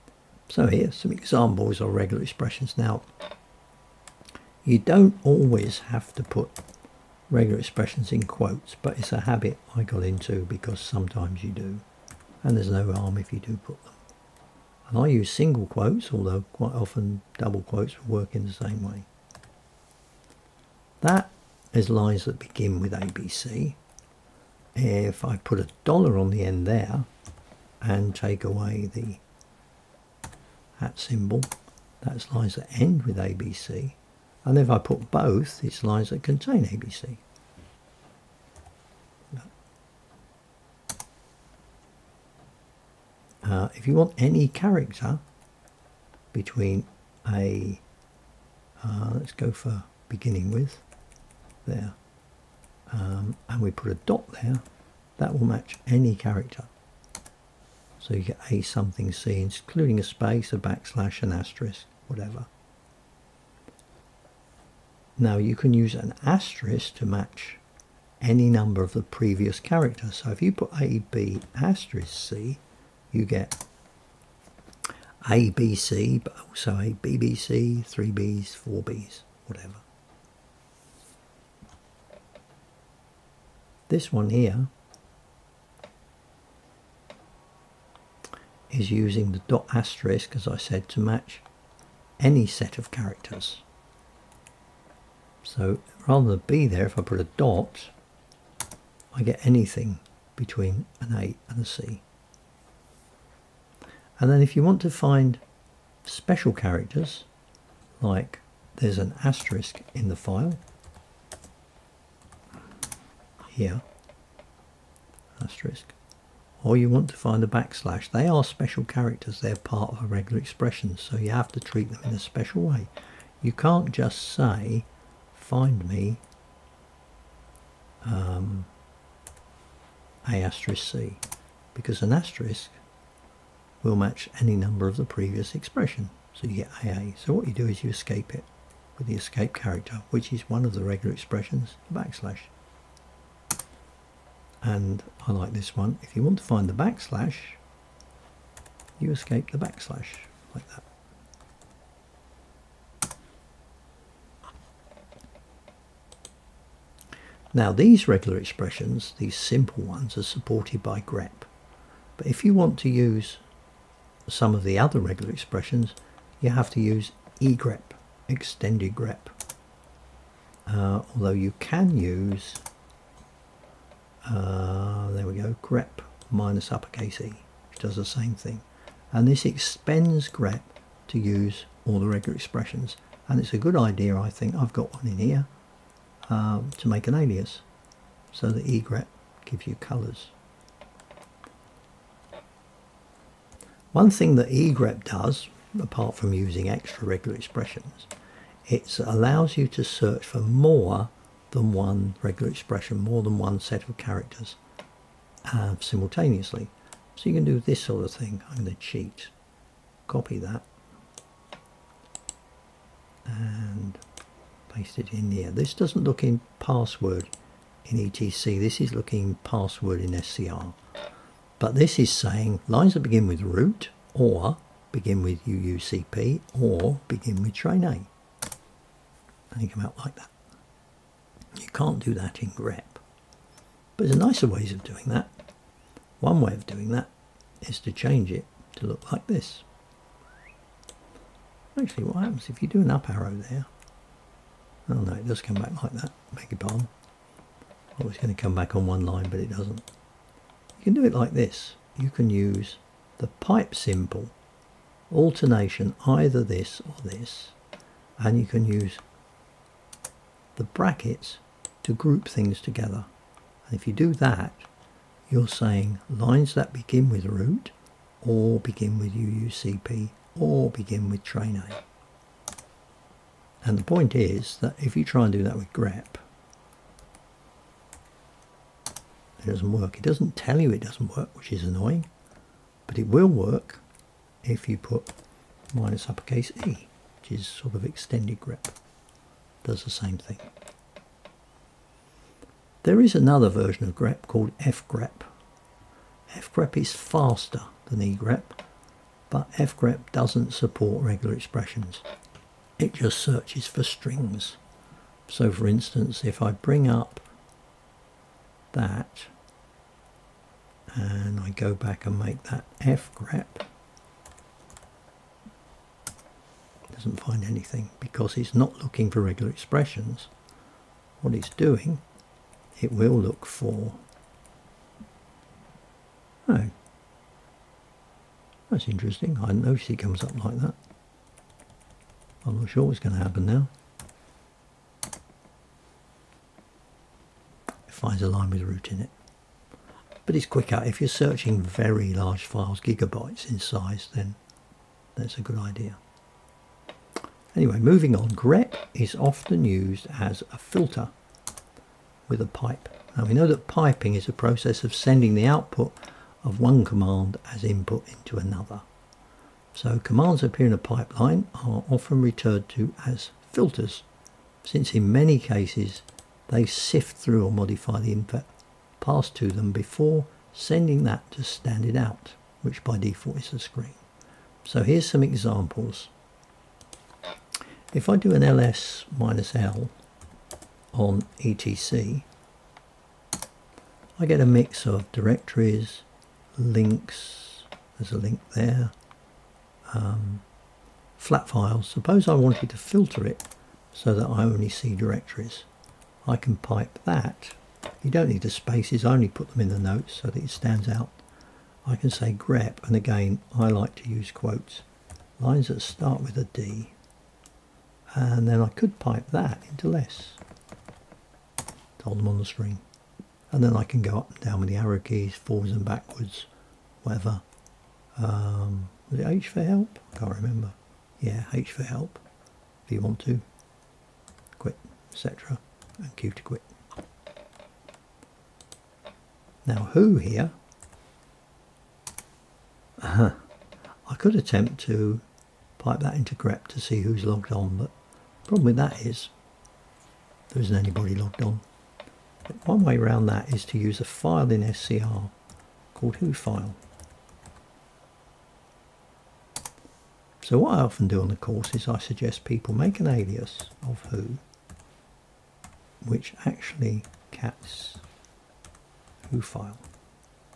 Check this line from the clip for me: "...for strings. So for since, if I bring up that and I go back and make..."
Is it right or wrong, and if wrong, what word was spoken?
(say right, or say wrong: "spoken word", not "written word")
wrong: "instance", not "since".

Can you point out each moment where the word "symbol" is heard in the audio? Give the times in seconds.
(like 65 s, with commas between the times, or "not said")
30 s, 253 s.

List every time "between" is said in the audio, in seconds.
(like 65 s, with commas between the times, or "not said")
46 s, 100 s.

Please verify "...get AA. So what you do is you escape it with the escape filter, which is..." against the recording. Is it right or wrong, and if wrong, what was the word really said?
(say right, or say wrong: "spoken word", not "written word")
wrong: "character", not "filter".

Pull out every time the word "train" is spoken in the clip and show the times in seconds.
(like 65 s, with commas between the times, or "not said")
227 s, 271 s.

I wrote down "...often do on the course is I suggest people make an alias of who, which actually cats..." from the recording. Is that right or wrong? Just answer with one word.
right.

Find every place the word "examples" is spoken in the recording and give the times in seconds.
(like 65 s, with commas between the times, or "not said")
1 s, 375 s.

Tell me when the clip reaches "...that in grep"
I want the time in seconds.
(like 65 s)
232 s.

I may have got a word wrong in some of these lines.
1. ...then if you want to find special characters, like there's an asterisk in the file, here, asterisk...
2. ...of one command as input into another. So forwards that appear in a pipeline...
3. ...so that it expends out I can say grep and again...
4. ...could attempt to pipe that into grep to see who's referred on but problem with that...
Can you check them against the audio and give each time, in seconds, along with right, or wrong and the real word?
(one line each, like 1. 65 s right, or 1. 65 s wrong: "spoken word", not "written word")
1. 104 s right
2. 356 s wrong: "commands", not "forwards"
3. 400 s wrong: "stands", not "expends"
4. 434 s wrong: "logged", not "referred".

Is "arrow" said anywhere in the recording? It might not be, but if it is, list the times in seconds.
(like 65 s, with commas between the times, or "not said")
243 s, 414 s.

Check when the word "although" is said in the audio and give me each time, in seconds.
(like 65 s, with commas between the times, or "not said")
16 s, 171 s.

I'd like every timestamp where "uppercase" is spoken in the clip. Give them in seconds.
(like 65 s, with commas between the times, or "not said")
176 s, 286 s.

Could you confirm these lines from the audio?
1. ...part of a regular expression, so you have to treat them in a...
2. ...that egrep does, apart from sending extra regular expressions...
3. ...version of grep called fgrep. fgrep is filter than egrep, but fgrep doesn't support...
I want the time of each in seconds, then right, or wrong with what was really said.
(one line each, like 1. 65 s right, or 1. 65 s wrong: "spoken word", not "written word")
1. 119 s right
2. 194 s wrong: "using", not "sending"
3. 293 s wrong: "faster", not "filter".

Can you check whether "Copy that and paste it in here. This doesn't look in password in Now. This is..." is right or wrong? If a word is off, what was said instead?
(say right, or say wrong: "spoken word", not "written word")
wrong: "ETC", not "Now".